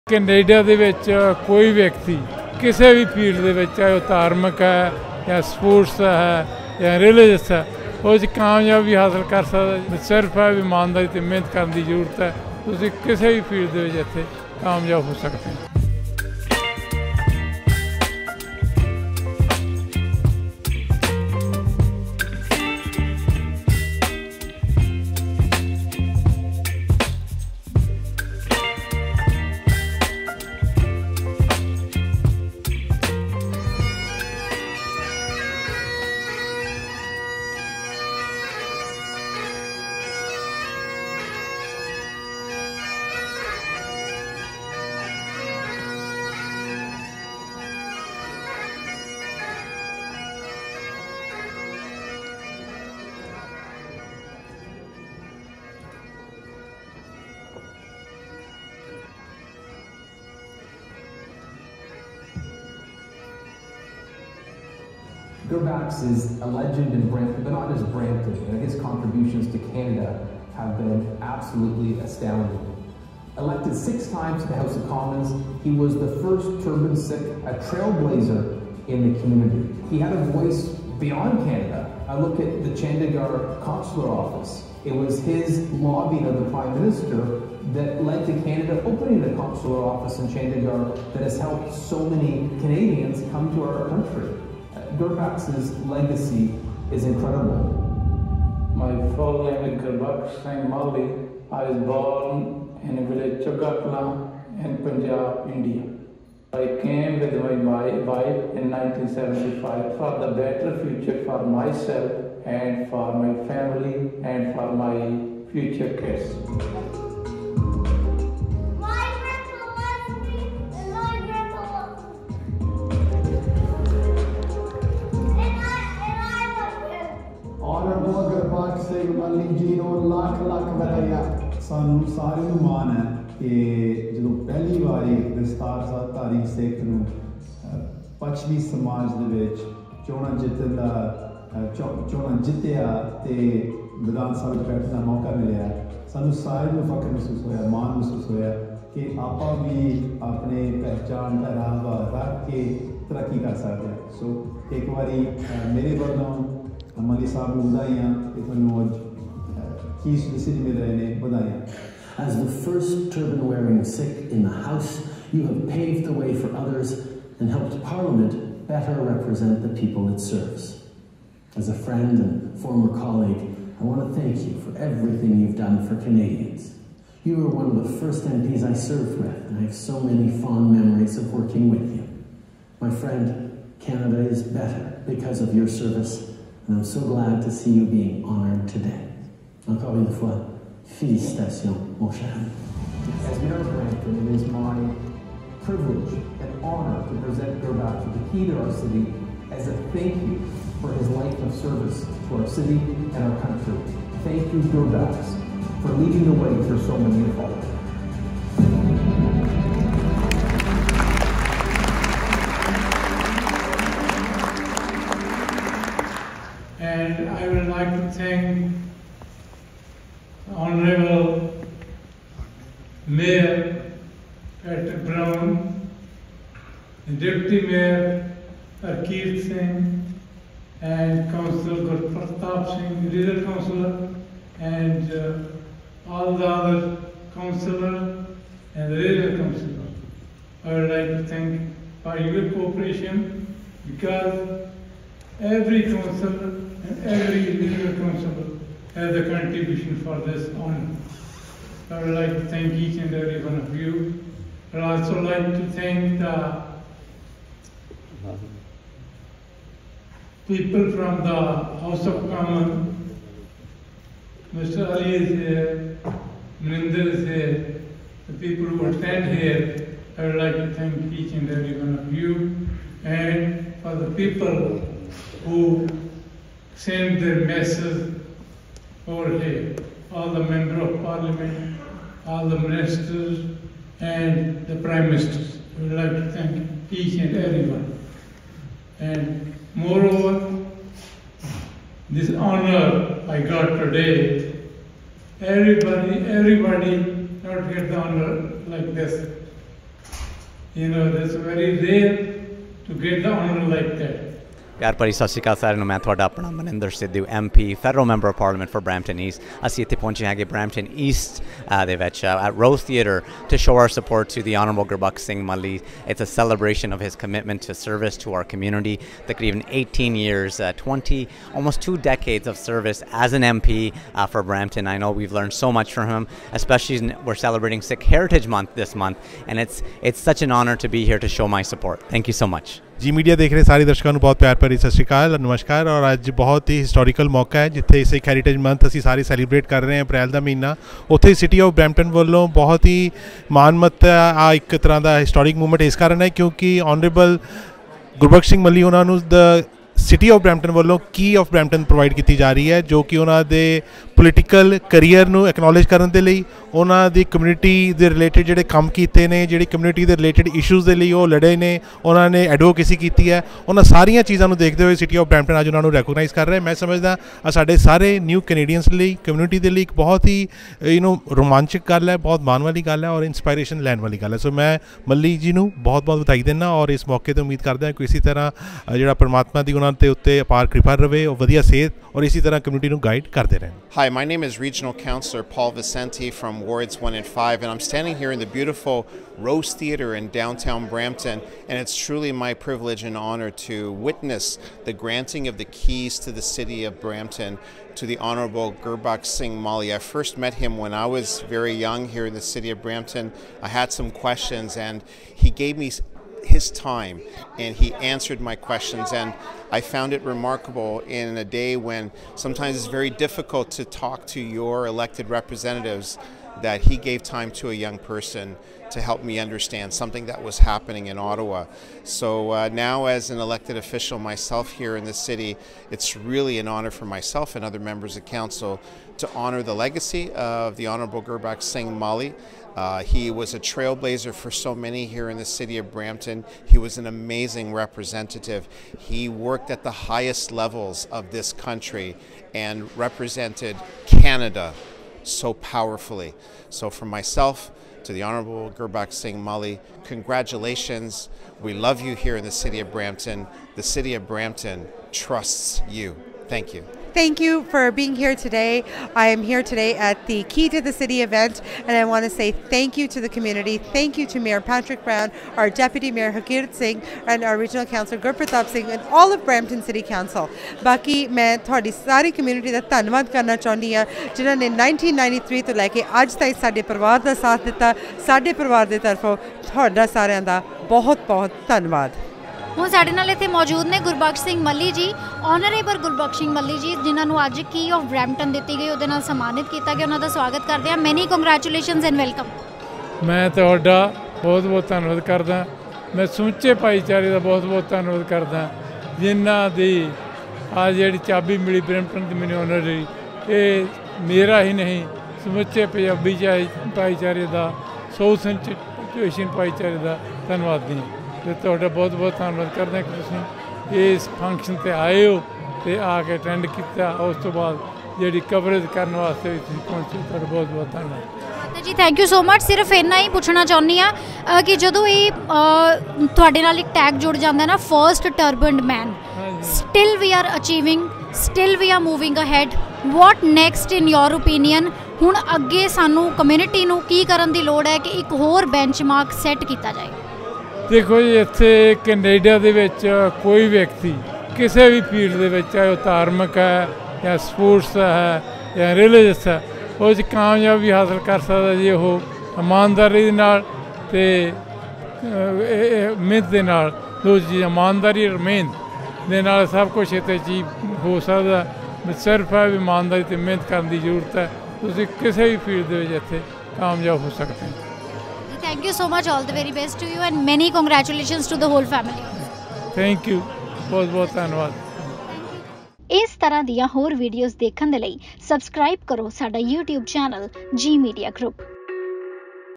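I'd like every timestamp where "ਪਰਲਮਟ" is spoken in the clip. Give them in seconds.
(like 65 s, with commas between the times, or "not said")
308 s.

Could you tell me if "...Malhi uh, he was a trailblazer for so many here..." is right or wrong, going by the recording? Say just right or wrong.
right.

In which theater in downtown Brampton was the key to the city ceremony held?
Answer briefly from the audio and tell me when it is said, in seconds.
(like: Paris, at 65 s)
Rose Theater, at 389 s.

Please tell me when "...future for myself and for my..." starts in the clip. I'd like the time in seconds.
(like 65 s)
110 s.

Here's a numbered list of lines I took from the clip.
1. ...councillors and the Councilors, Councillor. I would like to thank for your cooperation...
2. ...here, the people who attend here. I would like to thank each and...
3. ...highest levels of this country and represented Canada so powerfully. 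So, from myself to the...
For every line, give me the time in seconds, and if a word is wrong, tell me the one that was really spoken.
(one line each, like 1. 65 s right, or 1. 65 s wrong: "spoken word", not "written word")
1. 237 s right
2. 267 s right
3. 439 s right.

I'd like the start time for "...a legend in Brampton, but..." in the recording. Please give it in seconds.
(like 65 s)
66 s.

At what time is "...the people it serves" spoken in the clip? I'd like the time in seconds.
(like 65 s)
169 s.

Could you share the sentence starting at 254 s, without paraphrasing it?
I'd also like to thank the people from the House of Commons.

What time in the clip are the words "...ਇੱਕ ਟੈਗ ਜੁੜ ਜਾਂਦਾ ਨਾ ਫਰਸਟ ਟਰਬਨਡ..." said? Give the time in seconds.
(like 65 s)
526 s.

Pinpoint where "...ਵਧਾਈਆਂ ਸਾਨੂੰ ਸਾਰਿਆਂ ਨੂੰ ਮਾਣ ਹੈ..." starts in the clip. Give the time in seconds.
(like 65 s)
130 s.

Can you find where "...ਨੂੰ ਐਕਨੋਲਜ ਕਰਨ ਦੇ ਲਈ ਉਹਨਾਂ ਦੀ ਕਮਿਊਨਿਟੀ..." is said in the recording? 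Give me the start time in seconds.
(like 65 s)
355 s.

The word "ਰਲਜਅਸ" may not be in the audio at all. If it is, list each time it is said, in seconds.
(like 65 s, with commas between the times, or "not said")
6 s, 548 s.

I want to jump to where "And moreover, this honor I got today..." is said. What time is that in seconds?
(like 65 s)
288 s.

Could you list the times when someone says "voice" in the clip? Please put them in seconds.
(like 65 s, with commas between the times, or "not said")
80 s.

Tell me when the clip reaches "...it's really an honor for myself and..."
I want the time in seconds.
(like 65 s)
425 s.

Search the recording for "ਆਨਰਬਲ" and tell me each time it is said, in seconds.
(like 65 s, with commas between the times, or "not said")
314 s, 346 s, 485 s.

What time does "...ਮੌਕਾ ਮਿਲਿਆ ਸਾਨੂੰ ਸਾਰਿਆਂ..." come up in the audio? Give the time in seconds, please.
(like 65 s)
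145 s.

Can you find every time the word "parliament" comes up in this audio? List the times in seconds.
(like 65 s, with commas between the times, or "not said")
167 s, 281 s.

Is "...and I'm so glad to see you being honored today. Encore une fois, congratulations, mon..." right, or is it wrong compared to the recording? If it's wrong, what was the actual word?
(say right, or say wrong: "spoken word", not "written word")
wrong: "félicitations", not "congratulations".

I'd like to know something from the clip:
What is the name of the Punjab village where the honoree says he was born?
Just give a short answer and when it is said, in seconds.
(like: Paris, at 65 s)
Chagakla, at 103 s.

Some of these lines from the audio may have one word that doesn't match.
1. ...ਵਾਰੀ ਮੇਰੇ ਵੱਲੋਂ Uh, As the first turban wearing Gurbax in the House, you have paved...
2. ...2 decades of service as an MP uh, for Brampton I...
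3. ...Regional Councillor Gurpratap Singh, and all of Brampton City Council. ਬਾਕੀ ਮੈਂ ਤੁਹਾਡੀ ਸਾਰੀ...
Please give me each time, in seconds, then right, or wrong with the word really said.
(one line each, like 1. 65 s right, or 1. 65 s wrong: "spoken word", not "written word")
1. 154 s wrong: "Sikh", not "Gurbax"
2. 321 s right
3. 467 s right.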